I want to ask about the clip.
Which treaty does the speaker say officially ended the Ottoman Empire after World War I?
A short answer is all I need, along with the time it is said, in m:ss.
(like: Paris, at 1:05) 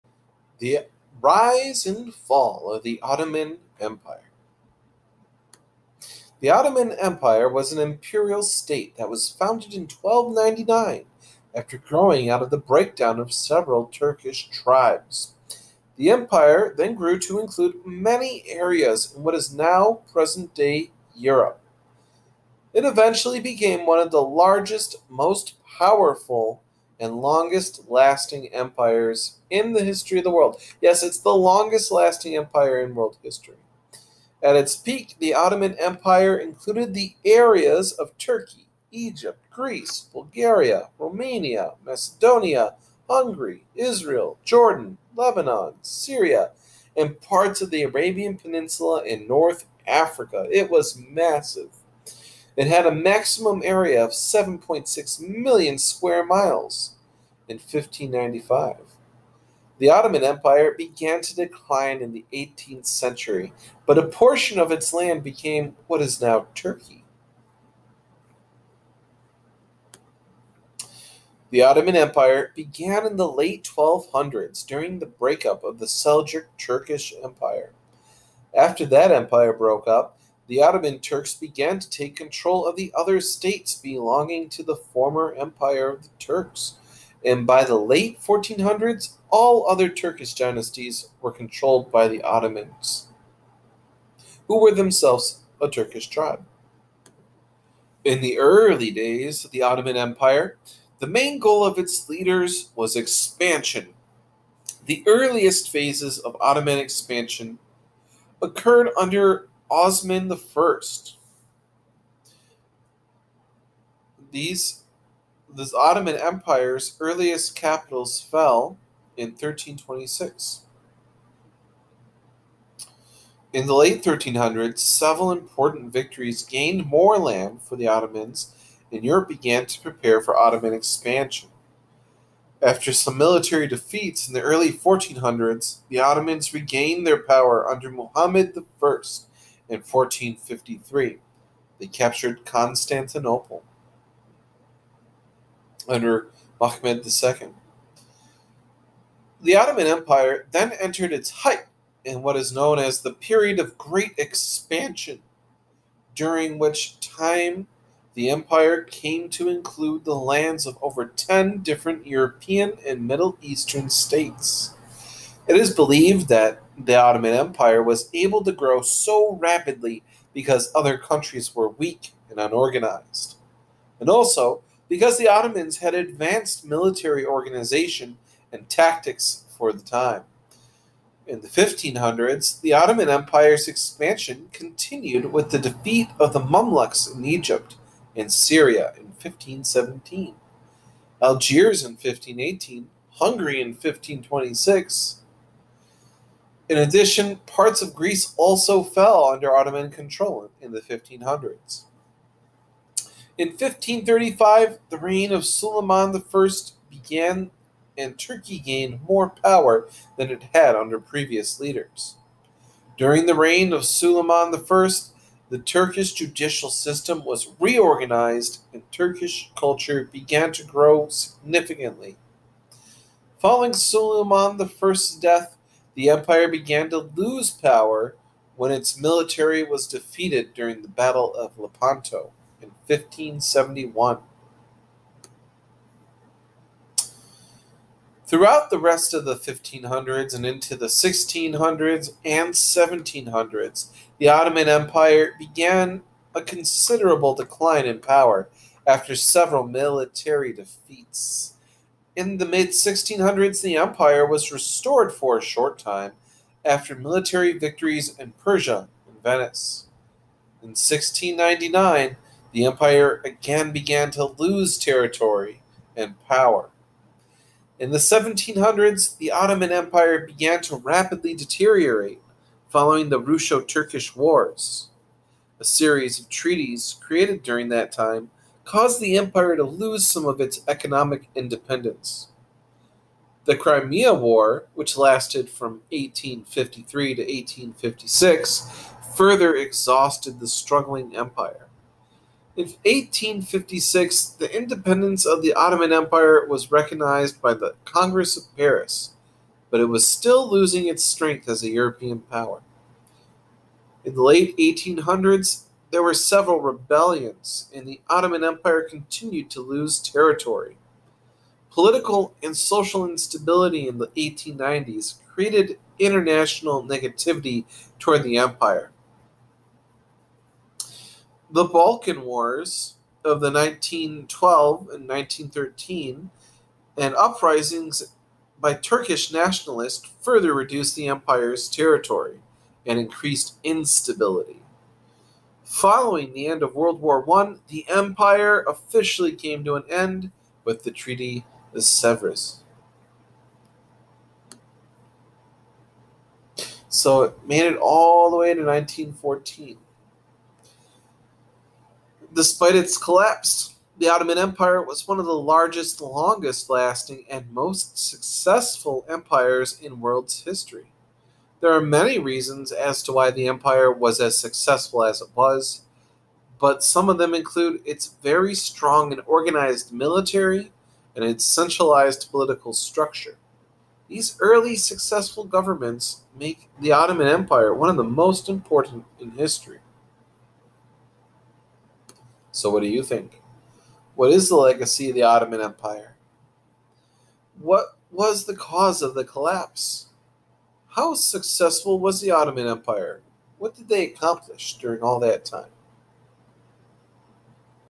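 Treaty of Sevres, at 5:40.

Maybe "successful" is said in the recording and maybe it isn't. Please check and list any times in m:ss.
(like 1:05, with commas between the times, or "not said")
5:57, 6:04, 6:14, 6:31.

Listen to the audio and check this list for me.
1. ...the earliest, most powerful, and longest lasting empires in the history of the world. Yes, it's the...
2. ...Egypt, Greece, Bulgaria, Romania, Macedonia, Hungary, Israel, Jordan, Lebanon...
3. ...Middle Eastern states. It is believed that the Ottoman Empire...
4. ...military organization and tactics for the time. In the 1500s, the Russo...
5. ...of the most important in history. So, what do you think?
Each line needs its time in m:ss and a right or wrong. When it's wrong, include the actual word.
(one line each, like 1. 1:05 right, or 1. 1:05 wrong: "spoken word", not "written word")
1. 0:24 wrong: "largest", not "earliest"
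2. 0:38 right
3. 2:43 right
4. 2:56 wrong: "Ottoman", not "Russo"
5. 6:17 right.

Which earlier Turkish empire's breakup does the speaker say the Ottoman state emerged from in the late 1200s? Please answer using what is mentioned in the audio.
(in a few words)
Seljuk Turkish Empire.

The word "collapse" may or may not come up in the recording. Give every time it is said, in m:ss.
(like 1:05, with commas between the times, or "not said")
5:52, 6:29.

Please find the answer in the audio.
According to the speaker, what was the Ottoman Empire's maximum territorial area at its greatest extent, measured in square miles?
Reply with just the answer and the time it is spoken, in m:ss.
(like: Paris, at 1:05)
7.6 million square miles, at 0:54.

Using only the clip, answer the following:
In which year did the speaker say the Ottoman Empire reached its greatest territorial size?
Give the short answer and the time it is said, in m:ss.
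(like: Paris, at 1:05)
1595, at 0:57.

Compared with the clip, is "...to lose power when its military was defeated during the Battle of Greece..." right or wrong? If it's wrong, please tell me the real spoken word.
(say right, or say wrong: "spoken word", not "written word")
wrong: "Lepanto", not "Greece".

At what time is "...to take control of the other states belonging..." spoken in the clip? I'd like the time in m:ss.
1:21.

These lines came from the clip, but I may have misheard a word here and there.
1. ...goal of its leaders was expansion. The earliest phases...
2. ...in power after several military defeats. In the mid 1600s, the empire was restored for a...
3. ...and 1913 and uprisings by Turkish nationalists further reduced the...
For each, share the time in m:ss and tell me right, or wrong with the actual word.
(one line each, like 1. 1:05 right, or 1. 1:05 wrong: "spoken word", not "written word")
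1. 1:41 right
2. 4:07 right
3. 5:24 right.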